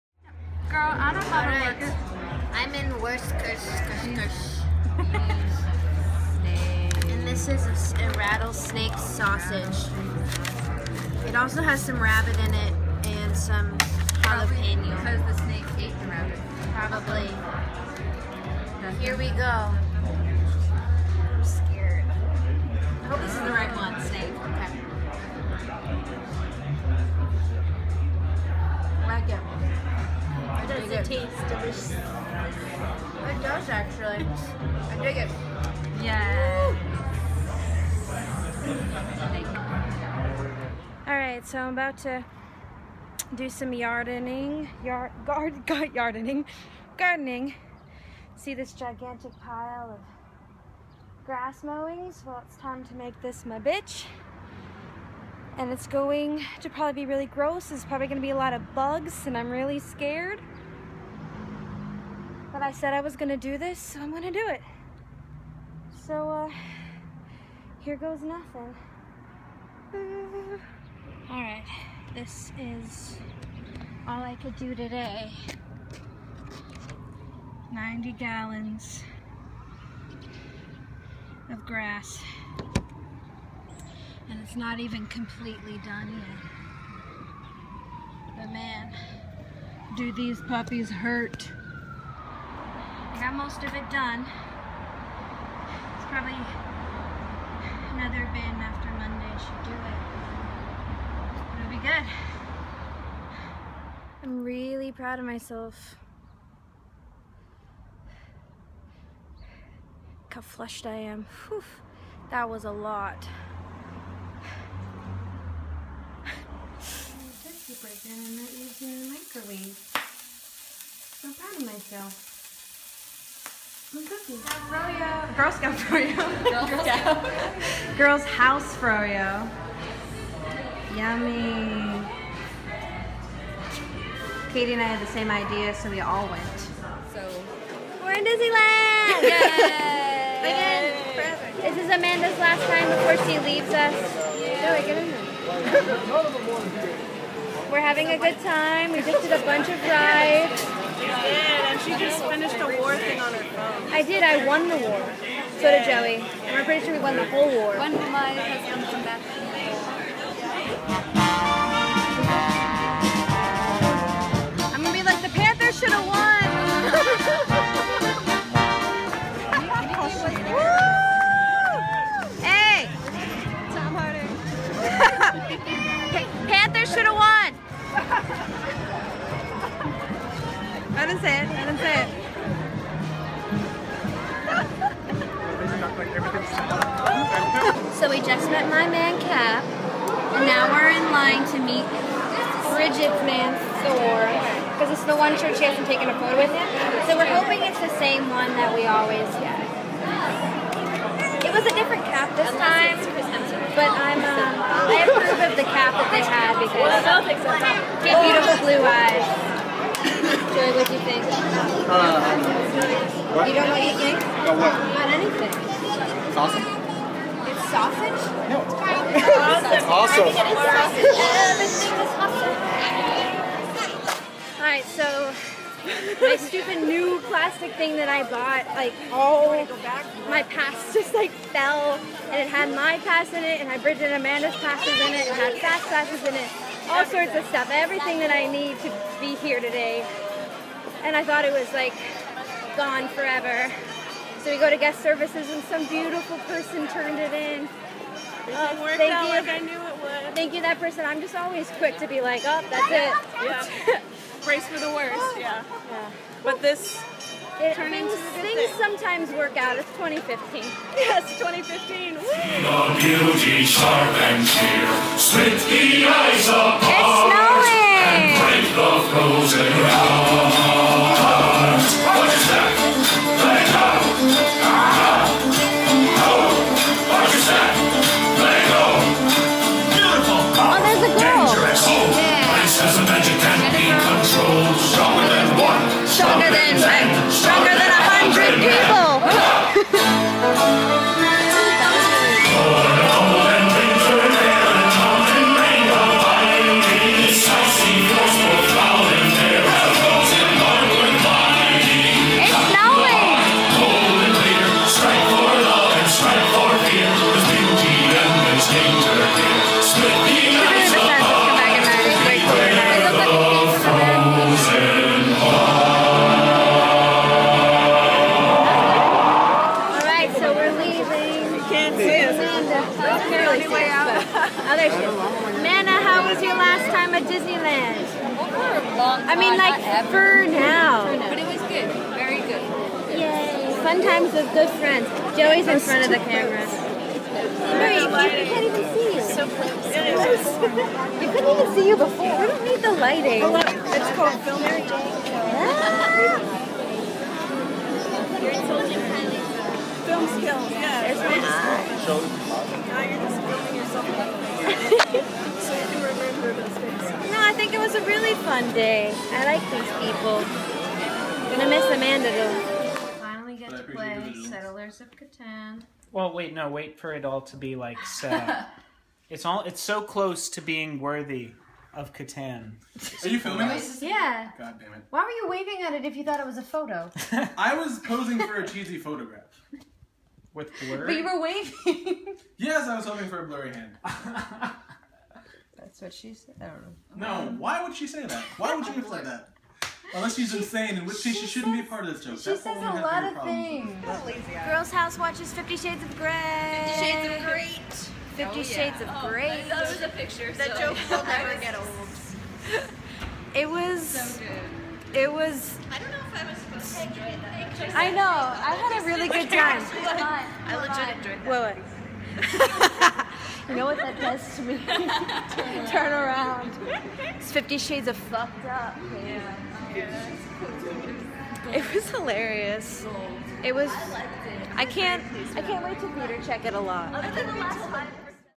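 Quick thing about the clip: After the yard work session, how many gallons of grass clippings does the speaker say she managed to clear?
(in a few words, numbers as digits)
90 gallons.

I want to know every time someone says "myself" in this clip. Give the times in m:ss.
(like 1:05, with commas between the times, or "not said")
1:45, 2:01.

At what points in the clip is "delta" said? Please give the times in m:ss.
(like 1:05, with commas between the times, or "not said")
not said.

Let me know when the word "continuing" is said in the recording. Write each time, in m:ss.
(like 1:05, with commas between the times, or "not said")
not said.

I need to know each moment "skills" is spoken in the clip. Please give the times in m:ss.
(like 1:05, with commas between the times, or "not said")
5:50.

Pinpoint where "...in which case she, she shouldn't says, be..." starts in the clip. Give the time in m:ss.
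6:30.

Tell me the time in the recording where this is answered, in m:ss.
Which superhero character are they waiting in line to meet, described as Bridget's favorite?
3:13.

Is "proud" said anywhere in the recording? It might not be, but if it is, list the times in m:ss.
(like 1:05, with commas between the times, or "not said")
1:44, 2:01.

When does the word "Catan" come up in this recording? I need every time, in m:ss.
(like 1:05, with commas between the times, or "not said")
6:05, 6:12.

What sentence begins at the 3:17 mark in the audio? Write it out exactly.
So we're hoping it's the same one that we always get.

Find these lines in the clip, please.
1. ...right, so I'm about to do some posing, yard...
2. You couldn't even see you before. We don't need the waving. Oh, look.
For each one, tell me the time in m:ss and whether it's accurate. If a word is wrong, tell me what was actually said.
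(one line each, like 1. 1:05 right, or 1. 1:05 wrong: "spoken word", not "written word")
1. 0:41 wrong: "yardening", not "posing"
2. 5:39 wrong: "lighting", not "waving".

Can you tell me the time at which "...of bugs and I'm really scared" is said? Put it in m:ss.
0:58.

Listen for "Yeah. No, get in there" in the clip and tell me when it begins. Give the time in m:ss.
2:24.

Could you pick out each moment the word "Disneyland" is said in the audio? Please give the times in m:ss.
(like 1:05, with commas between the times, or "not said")
2:18, 5:27.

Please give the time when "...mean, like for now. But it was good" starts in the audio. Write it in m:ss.
5:29.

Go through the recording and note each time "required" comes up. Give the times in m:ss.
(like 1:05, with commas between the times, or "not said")
not said.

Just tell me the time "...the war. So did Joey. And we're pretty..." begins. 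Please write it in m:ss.
2:34.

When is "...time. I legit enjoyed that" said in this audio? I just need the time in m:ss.
6:49.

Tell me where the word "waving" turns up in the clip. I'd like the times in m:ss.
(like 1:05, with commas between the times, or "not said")
6:15, 6:21.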